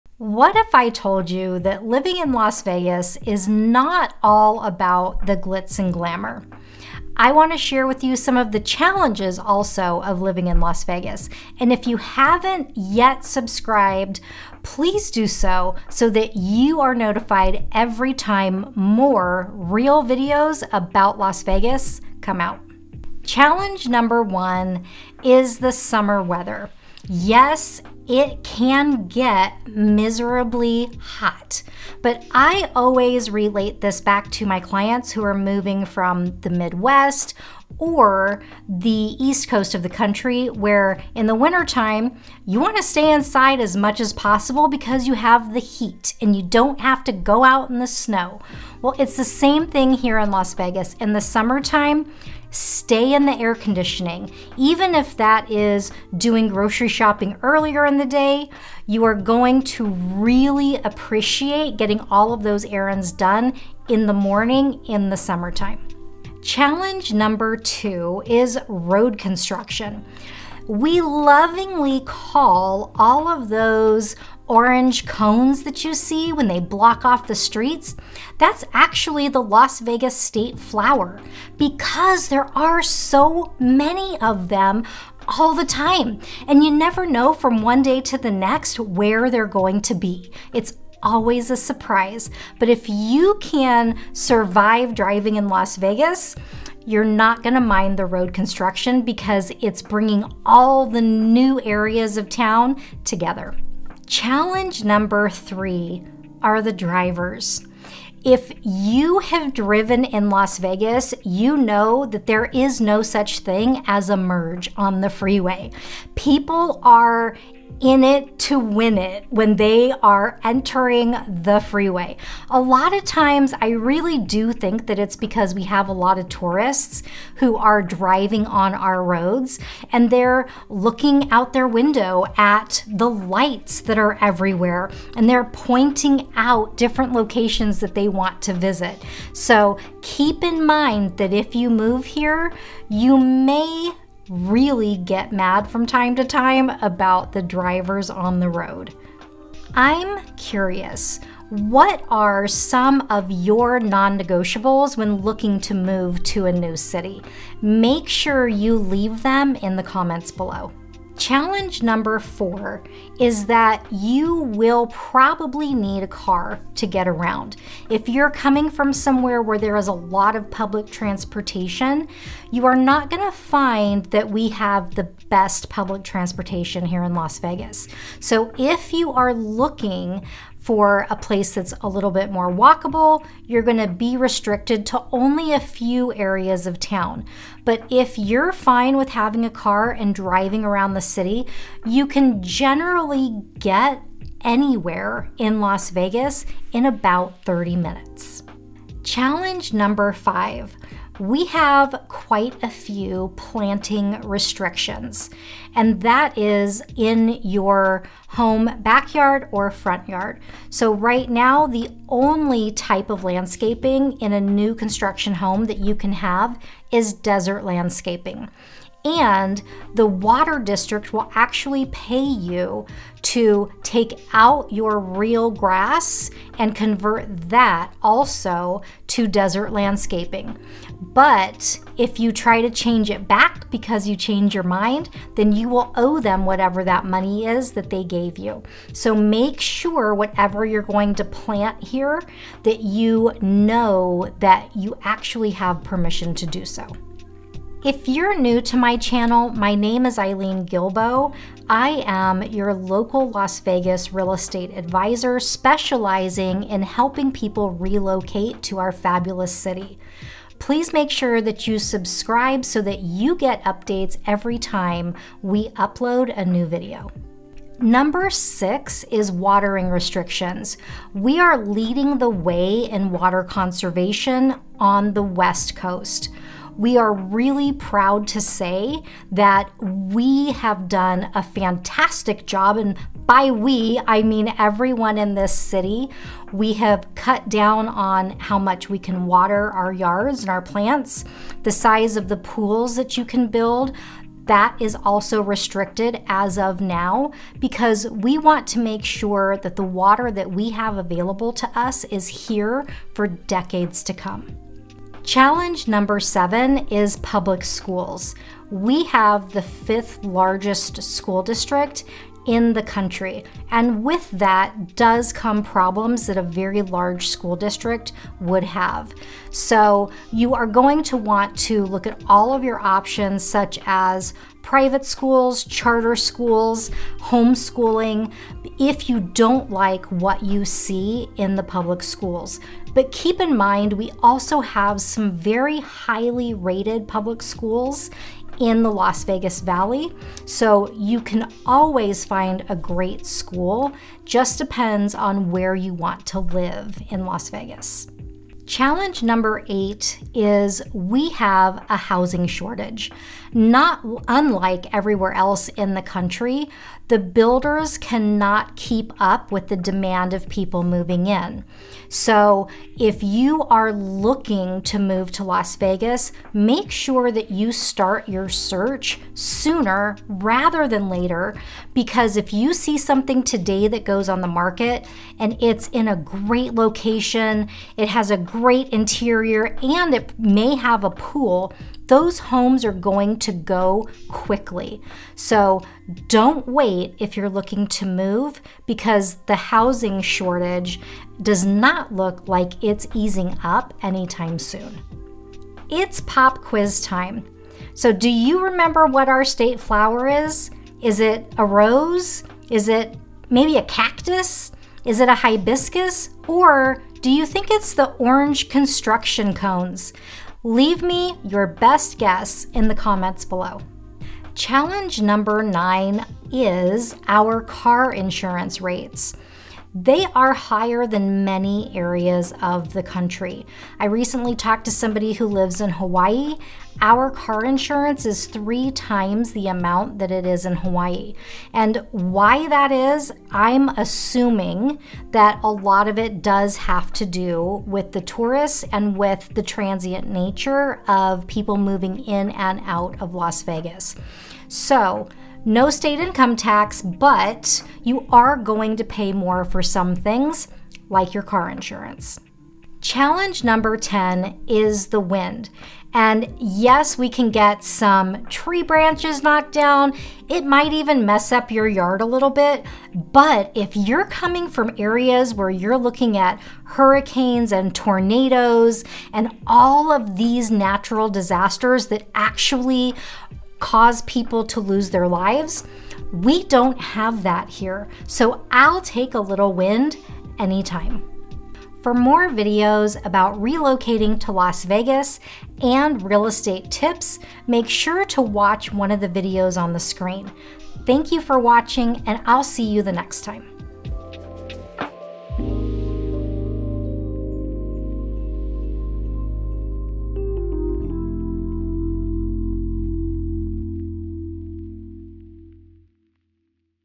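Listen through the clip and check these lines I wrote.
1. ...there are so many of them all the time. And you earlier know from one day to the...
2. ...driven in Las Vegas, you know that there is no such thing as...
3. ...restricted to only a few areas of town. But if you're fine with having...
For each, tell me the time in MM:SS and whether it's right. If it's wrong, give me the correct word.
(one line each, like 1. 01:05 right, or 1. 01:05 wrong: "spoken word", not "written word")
1. 01:22 wrong: "never", not "earlier"
2. 01:49 right
3. 03:04 right.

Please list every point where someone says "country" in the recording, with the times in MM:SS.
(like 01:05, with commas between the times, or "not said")
00:39, 05:12, 05:56, 07:03.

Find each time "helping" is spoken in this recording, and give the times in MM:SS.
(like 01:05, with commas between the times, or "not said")
04:16.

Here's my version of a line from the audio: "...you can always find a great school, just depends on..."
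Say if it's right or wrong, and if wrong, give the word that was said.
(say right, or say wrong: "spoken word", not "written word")
right.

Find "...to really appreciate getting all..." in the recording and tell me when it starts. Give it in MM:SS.
00:59.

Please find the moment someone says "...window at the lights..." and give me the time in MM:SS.
02:11.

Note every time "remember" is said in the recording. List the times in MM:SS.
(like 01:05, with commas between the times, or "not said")
06:38.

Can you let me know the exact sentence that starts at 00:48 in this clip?
Well, it's the same thing here in Las Vegas.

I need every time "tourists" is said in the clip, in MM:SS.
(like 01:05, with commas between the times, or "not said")
02:06, 07:18.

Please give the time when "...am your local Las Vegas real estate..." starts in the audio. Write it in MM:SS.
04:12.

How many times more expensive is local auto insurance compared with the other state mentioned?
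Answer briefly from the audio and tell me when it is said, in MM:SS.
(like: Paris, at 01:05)
3 times, at 07:08.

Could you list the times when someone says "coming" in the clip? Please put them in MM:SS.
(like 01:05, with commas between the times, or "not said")
02:48, 07:44.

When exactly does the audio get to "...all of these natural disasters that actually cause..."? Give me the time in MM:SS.
07:49.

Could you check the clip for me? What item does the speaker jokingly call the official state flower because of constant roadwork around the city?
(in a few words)
orange cones.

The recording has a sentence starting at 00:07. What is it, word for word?
I want to share with you some of the challenges also of living in Las Vegas.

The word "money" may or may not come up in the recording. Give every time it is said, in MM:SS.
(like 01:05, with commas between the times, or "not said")
03:57.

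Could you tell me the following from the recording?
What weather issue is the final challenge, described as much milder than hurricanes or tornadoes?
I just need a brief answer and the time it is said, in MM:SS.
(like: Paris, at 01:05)
the wind, at 07:35.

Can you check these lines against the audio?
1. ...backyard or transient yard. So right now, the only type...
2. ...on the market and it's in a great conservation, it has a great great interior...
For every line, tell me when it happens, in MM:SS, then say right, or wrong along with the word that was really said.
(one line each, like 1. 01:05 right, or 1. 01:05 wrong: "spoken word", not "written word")
1. 03:28 wrong: "front", not "transient"
2. 06:14 wrong: "location", not "conservation".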